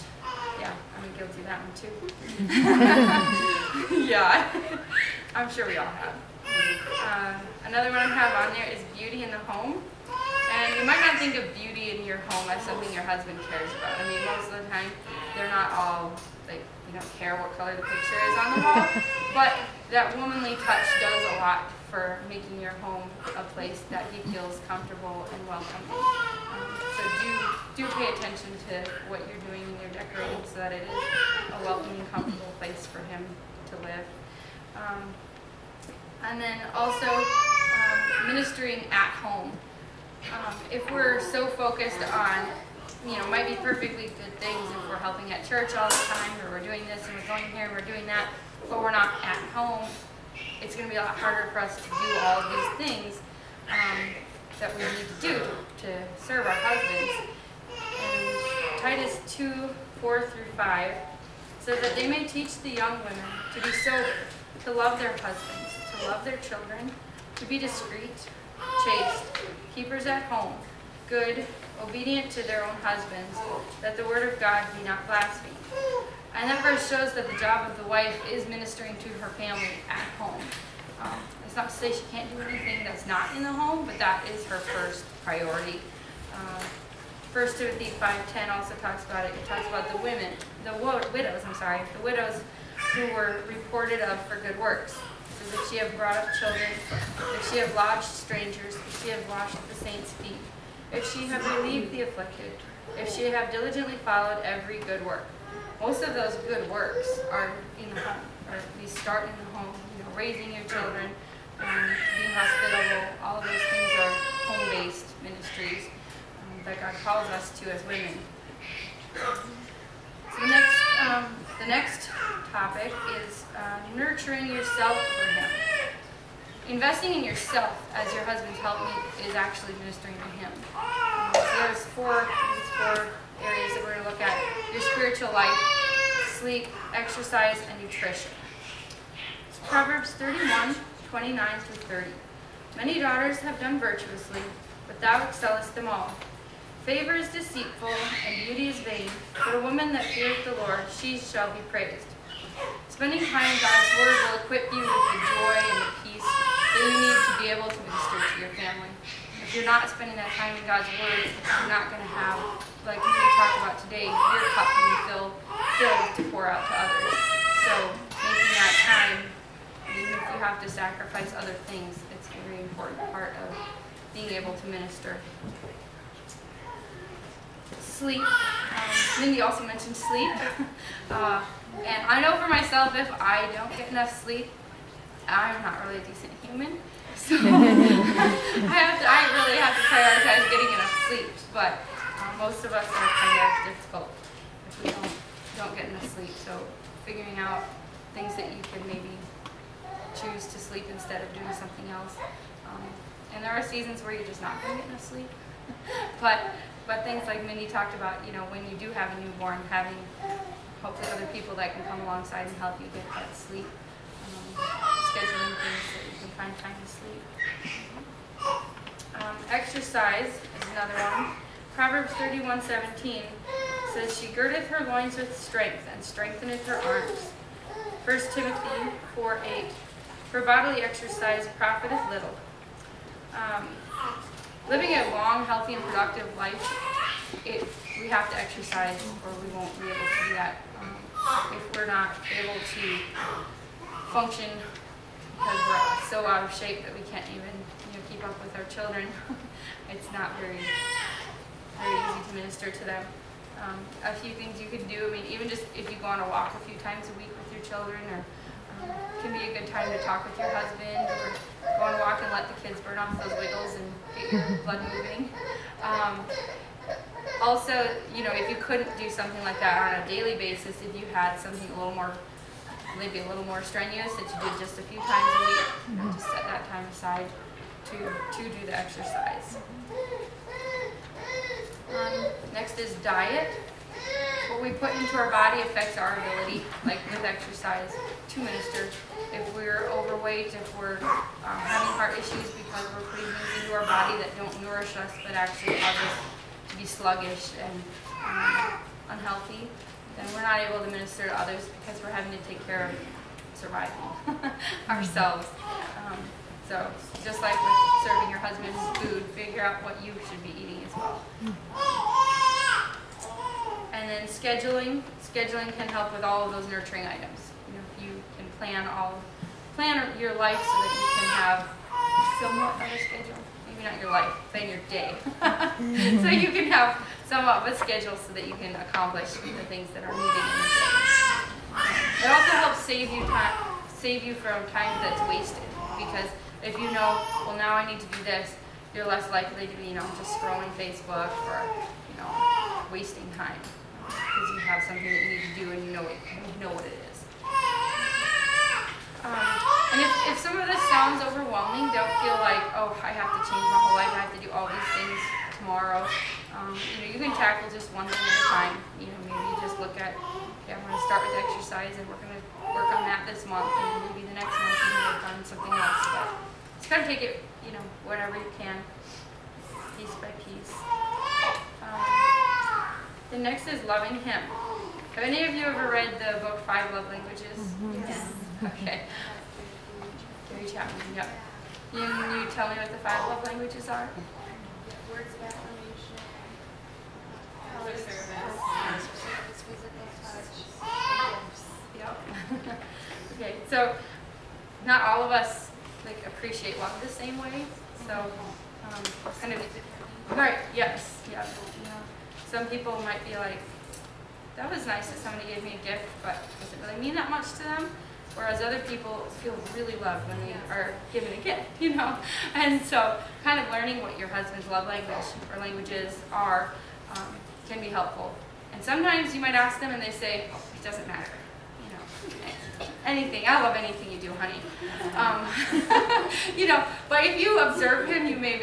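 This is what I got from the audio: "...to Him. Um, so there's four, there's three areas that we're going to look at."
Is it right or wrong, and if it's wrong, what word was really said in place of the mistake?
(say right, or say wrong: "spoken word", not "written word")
wrong: "four", not "three".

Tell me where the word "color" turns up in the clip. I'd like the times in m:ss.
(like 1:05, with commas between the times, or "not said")
0:17, 6:27.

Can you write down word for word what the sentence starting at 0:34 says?
Um, and then also um, ministering at home.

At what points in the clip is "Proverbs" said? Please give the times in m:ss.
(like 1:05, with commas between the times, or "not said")
2:19, 3:41.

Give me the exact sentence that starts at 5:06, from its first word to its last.
Um, so just like with serving your husband's food, figure out what you should be eating as well.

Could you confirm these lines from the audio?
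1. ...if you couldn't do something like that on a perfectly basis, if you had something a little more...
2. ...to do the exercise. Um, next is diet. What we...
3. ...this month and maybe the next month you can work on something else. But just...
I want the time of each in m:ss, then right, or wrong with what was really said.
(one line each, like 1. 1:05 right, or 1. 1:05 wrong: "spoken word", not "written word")
1. 4:28 wrong: "daily", not "perfectly"
2. 4:37 right
3. 6:03 right.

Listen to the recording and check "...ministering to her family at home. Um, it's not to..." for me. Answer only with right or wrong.
right.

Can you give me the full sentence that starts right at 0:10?
And you might not think of beauty in your home as something your husband cares about.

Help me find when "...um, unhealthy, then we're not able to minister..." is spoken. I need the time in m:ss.
4:58.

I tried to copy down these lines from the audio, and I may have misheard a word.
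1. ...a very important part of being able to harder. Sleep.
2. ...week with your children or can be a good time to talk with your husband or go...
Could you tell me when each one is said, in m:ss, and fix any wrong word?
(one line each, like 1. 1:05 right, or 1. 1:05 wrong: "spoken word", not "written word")
1. 2:52 wrong: "minister", not "harder"
2. 4:17 right.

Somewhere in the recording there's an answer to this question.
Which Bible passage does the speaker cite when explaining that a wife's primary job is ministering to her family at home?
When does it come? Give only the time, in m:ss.
0:58.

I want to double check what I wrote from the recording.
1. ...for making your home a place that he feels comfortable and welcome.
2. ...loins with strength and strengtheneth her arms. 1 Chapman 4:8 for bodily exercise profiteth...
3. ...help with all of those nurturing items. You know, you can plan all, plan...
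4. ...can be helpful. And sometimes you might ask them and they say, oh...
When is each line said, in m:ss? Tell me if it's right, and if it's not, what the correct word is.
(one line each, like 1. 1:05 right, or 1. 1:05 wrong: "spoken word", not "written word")
1. 0:21 right
2. 3:44 wrong: "Timothy", not "Chapman"
3. 5:15 right
4. 6:57 right.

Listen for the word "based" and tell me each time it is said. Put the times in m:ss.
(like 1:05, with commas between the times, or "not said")
1:54.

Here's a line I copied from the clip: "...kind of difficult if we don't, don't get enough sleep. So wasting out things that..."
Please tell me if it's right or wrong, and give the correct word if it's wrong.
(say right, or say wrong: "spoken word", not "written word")
wrong: "figuring", not "wasting".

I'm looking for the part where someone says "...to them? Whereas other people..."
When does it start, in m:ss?
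6:47.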